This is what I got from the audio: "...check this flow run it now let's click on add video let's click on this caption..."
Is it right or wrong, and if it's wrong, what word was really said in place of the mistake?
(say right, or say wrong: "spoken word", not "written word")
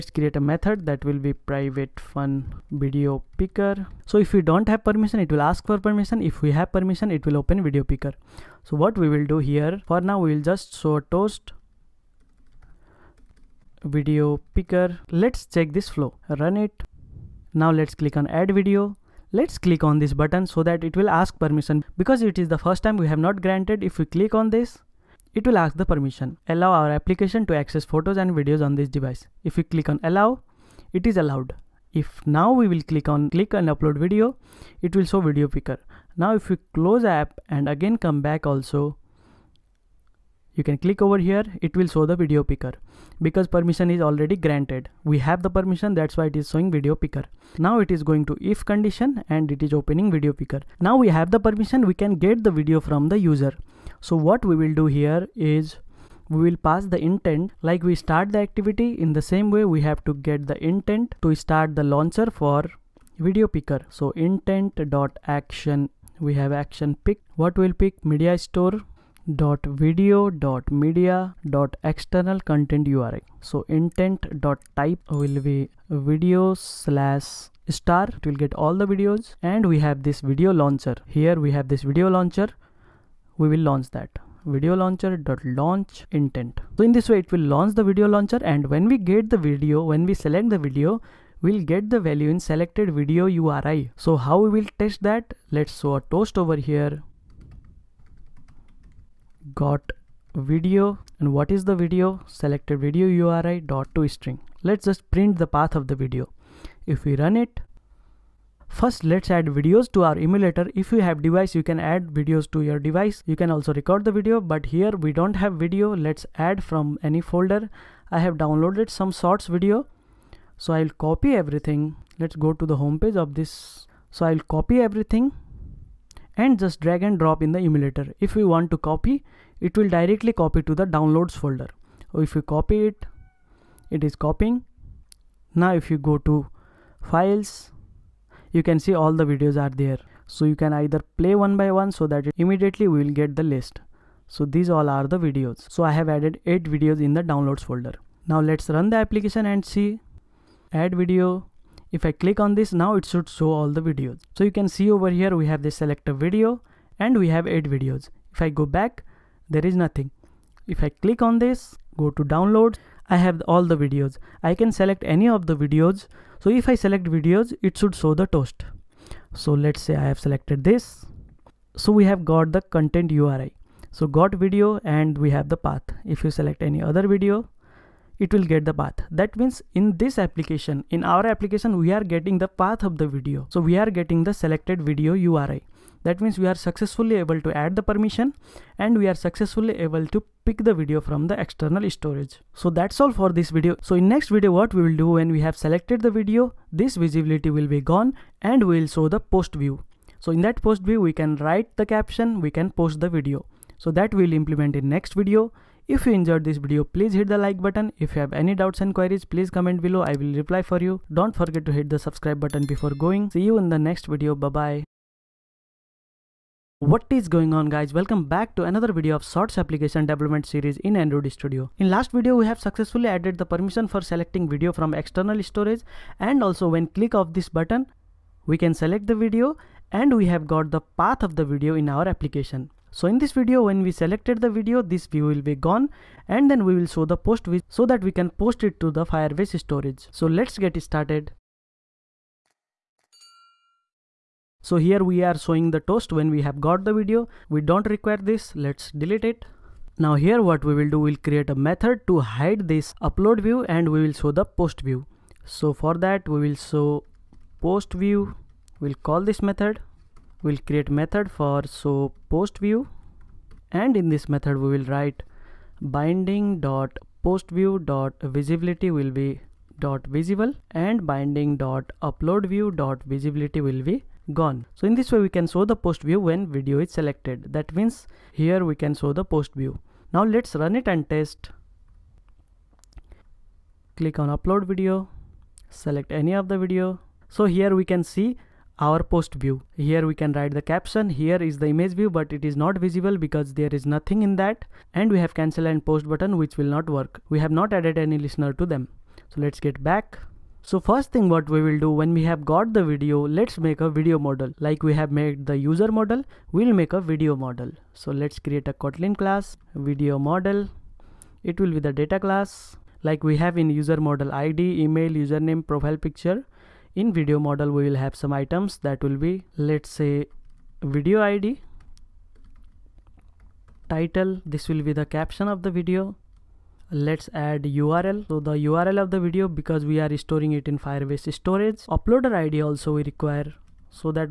wrong: "button", not "caption".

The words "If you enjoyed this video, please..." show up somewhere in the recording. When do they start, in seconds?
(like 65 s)
205 s.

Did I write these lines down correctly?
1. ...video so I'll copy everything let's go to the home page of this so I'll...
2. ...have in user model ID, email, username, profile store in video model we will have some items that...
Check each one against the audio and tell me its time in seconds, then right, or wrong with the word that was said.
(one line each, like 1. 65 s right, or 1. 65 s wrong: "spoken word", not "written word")
1. 119 s right
2. 313 s wrong: "picture", not "store".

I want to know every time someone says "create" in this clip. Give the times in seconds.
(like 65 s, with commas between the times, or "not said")
0 s, 251 s, 260 s, 308 s.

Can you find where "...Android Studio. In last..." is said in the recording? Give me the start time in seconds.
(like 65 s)
220 s.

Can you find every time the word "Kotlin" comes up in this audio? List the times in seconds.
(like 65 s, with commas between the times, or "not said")
308 s.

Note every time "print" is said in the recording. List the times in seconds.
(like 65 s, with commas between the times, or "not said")
105 s.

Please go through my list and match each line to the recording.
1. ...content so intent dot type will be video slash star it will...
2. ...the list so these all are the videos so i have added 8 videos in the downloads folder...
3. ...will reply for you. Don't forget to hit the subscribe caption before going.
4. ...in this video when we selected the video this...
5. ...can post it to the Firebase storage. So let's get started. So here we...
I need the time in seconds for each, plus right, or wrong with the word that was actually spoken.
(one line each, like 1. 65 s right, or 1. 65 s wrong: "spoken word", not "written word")
1. 72 s right
2. 143 s right
3. 210 s wrong: "button", not "caption"
4. 233 s right
5. 238 s right.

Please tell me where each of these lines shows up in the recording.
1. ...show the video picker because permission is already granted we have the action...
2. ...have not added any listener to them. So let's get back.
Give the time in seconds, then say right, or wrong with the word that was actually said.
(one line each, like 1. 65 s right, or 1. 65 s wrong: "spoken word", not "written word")
1. 41 s wrong: "permission", not "action"
2. 297 s right.